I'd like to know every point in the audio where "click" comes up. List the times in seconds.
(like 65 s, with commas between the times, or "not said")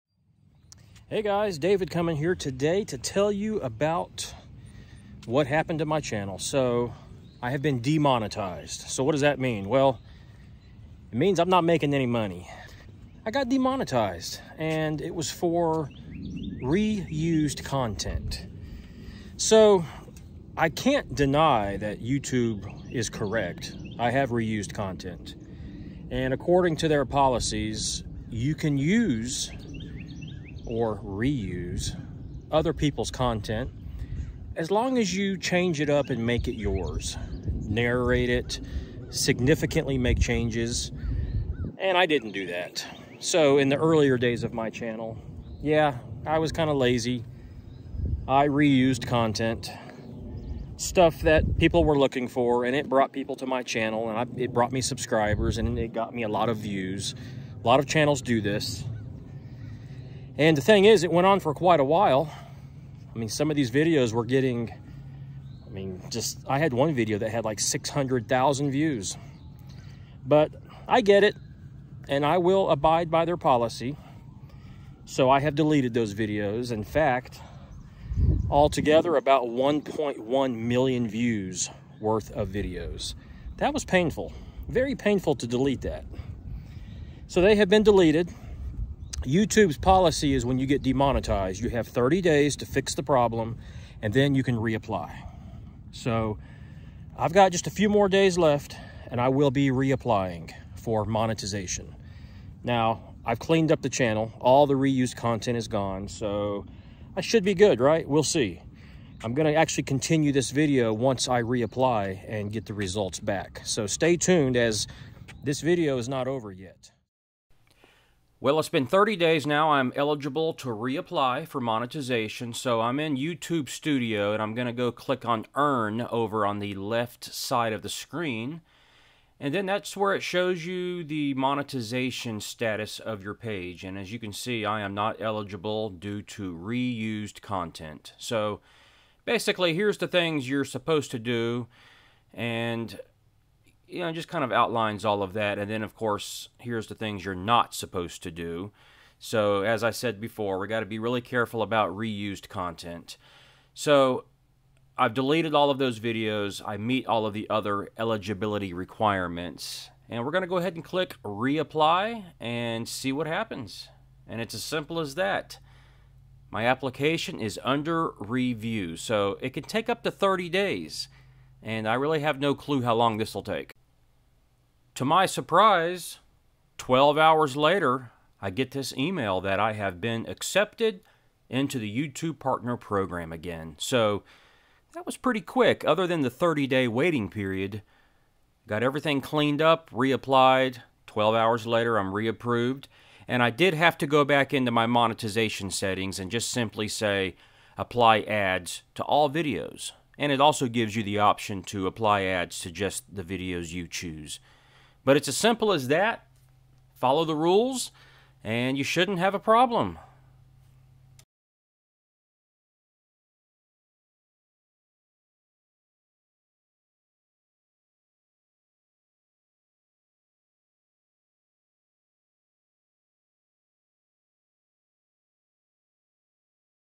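124 s, 160 s.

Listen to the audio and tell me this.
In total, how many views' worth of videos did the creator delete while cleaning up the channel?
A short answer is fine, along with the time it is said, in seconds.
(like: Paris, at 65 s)
1.1 million, at 79 s.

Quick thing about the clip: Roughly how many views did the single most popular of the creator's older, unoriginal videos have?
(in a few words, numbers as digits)
600,000.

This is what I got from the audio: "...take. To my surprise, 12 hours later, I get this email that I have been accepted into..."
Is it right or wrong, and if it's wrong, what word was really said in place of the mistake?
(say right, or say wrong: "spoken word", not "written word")
right.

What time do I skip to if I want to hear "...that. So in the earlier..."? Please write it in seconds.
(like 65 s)
42 s.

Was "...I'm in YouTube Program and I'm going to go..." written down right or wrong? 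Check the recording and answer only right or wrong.
wrong.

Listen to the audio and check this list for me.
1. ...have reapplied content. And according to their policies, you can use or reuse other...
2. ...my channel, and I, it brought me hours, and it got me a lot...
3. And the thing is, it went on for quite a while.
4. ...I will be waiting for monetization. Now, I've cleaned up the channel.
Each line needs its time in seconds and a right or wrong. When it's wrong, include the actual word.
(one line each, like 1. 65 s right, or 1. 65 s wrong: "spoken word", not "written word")
1. 24 s wrong: "reused", not "reapplied"
2. 53 s wrong: "subscribers", not "hours"
3. 60 s right
4. 99 s wrong: "reapplying", not "waiting".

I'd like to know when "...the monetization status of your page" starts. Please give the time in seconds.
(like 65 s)
131 s.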